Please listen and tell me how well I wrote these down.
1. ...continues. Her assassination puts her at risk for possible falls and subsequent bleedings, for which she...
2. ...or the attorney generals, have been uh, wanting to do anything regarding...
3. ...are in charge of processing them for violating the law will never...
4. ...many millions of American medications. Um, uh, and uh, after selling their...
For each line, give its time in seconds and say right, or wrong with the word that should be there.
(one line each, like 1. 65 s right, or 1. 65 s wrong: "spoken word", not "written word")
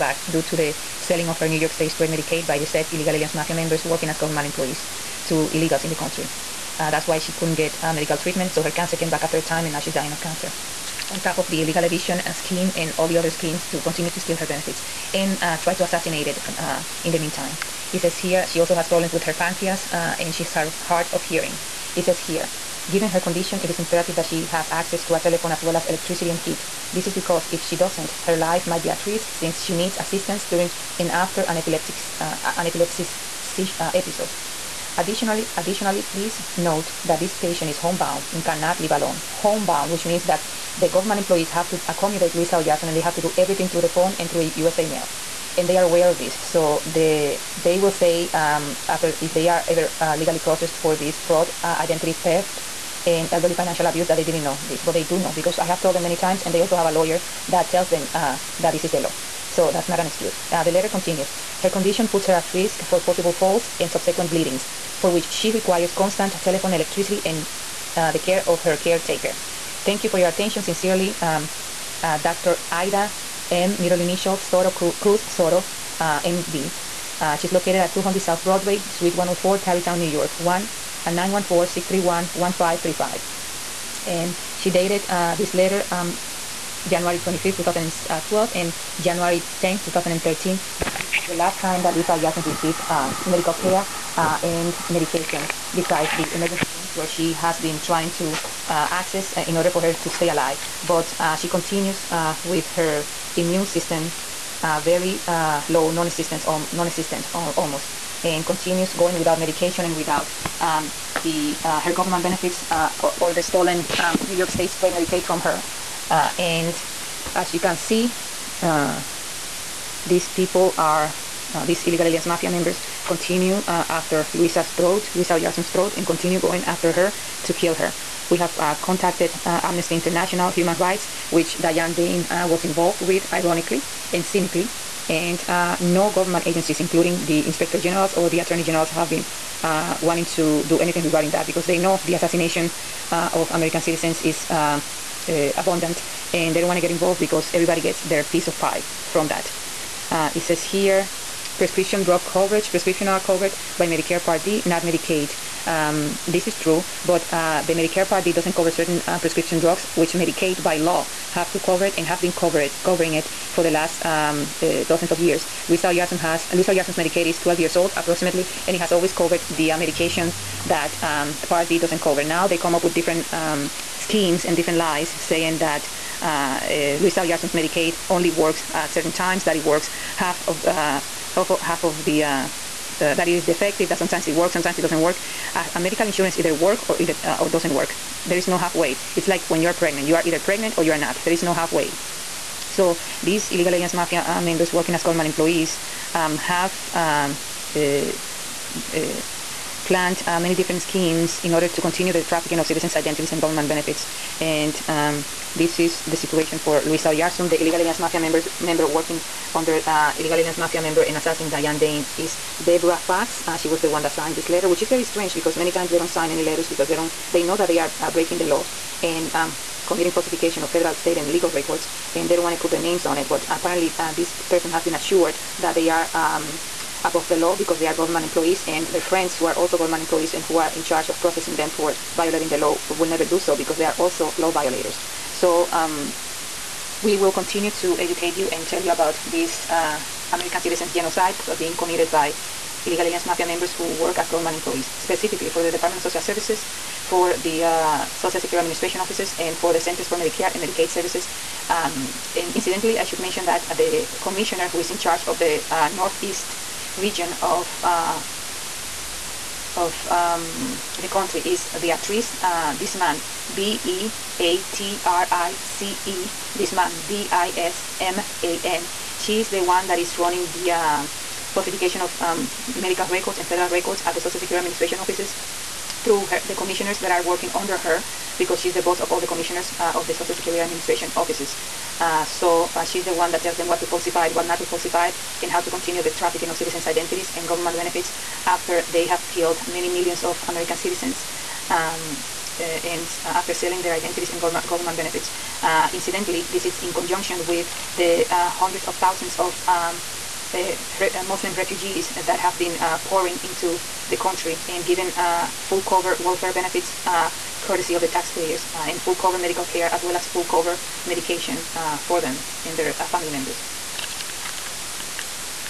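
1. 60 s wrong: "condition", not "assassination"
2. 138 s right
3. 230 s right
4. 289 s wrong: "citizens", not "medications".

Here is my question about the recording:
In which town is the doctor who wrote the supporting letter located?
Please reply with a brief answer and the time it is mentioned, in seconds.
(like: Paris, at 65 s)
Tarrytown, at 79 s.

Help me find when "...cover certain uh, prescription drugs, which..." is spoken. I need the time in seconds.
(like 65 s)
158 s.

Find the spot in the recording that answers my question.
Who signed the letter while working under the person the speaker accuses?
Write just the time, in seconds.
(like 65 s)
212 s.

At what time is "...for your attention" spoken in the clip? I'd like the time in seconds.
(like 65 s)
70 s.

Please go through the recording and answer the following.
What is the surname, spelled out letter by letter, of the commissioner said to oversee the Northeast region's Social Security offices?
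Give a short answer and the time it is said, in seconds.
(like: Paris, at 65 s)
Disman, at 267 s.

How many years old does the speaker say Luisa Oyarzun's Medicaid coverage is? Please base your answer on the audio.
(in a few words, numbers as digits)
12.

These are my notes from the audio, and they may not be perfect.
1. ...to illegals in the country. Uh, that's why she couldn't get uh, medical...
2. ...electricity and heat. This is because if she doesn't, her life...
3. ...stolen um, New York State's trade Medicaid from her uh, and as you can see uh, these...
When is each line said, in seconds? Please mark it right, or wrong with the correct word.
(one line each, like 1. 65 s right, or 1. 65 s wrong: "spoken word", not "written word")
1. 5 s right
2. 25 s right
3. 113 s right.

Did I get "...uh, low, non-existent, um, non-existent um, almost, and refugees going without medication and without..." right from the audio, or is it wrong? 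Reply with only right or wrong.
wrong.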